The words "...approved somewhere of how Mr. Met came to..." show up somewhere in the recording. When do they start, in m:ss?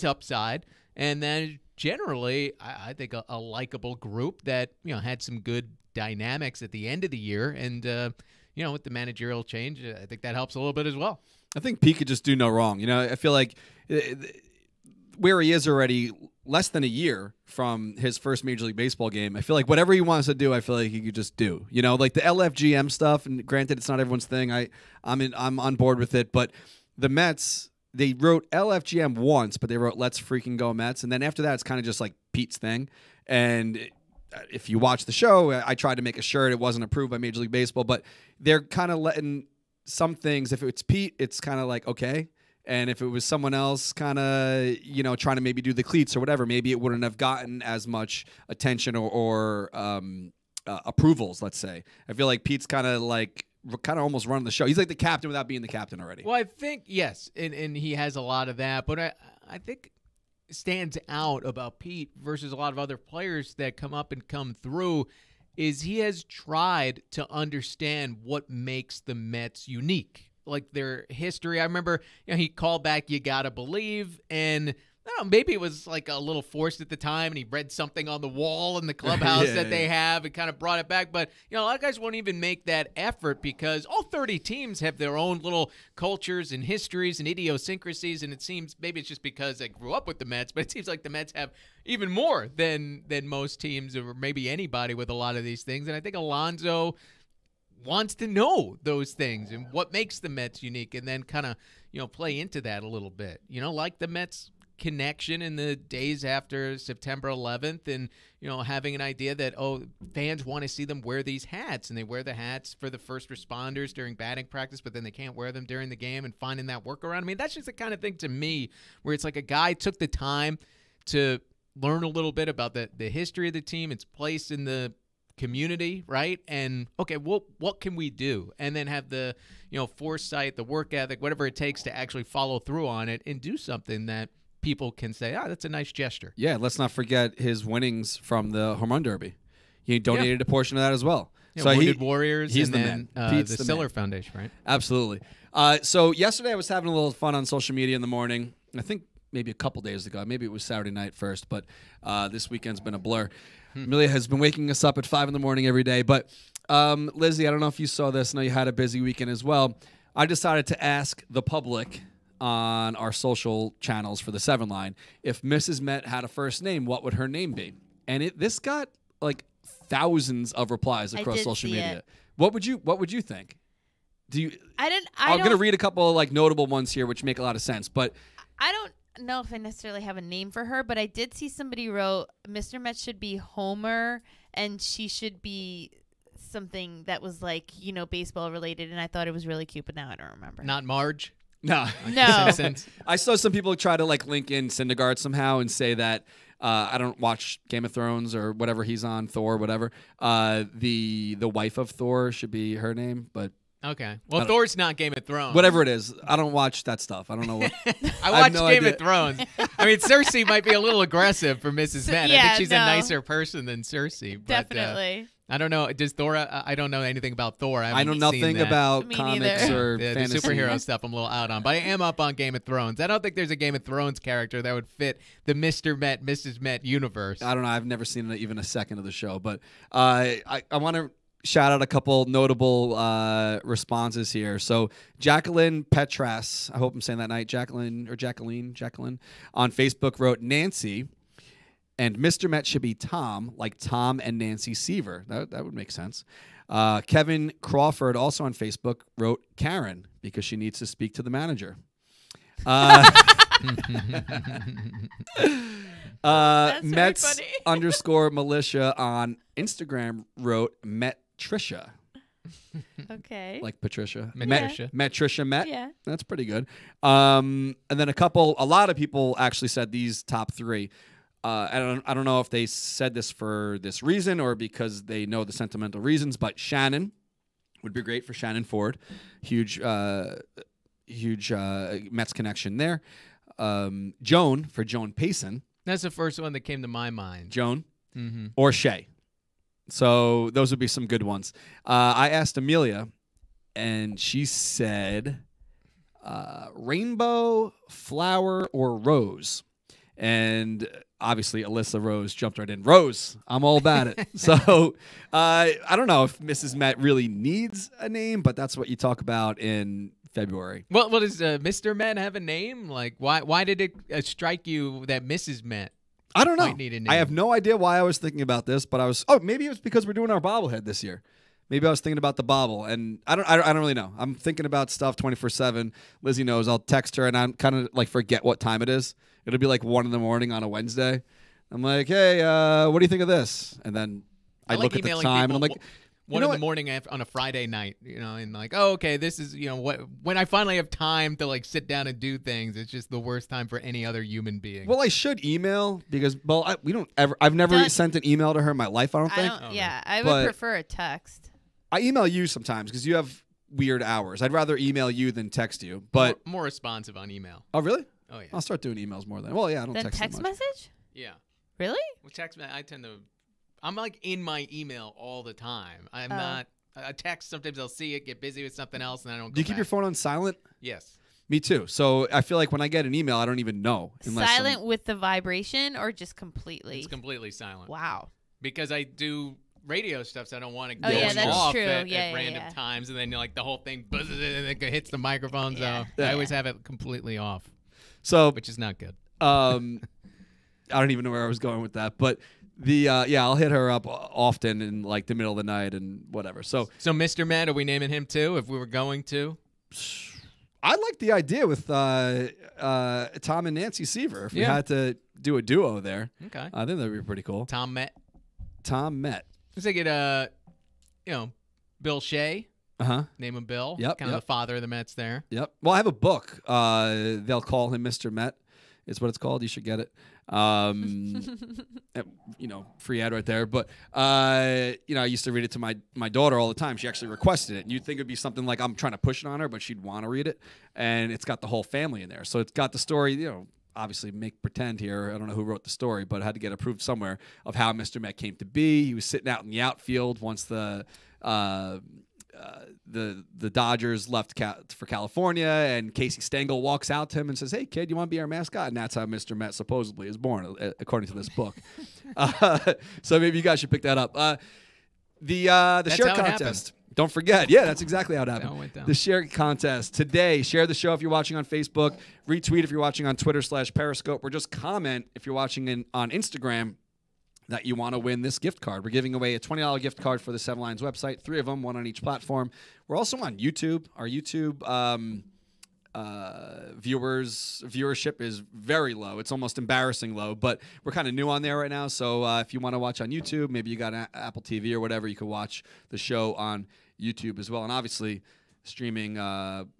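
7:16.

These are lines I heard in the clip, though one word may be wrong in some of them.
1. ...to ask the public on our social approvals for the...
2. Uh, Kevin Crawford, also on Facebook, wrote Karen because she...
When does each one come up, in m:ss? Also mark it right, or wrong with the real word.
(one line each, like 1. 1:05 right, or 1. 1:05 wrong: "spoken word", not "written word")
1. 2:40 wrong: "channels", not "approvals"
2. 4:06 right.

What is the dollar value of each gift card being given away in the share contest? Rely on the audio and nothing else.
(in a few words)
$20.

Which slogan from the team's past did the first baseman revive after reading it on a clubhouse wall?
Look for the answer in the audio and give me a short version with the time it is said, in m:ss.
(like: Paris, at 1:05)
You Gotta Believe, at 1:13.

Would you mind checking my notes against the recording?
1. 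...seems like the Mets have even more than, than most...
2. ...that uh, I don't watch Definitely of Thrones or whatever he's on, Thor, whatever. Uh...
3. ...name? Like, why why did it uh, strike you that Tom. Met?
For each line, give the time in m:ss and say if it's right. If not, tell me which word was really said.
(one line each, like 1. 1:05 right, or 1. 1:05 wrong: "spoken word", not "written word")
1. 1:30 right
2. 3:15 wrong: "Game", not "Definitely"
3. 5:12 wrong: "Mrs", not "Tom".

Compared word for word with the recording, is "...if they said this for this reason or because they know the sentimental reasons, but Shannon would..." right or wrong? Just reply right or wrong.
right.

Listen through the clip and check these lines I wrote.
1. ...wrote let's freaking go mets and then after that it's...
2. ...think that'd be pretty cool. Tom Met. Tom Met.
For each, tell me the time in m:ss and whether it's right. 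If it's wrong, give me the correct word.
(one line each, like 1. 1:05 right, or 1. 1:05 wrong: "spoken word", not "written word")
1. 0:29 right
2. 6:46 right.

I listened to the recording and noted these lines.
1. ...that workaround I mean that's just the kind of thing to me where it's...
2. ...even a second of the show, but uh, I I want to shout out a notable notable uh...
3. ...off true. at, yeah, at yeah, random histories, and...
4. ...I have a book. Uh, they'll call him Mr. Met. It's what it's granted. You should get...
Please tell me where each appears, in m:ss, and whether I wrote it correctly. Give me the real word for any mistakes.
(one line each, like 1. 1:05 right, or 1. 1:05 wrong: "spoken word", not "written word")
1. 1:56 right
2. 3:48 wrong: "couple", not "notable"
3. 6:21 wrong: "times", not "histories"
4. 6:55 wrong: "called", not "granted".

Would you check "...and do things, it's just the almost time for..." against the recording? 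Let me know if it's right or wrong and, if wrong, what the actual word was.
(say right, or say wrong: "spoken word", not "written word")
wrong: "worst", not "almost".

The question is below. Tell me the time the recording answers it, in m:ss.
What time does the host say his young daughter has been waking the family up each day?
2:35.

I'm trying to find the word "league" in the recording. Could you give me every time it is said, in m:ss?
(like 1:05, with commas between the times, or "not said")
0:18, 0:37.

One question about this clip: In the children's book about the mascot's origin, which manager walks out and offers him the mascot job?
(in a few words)
Casey Stengel.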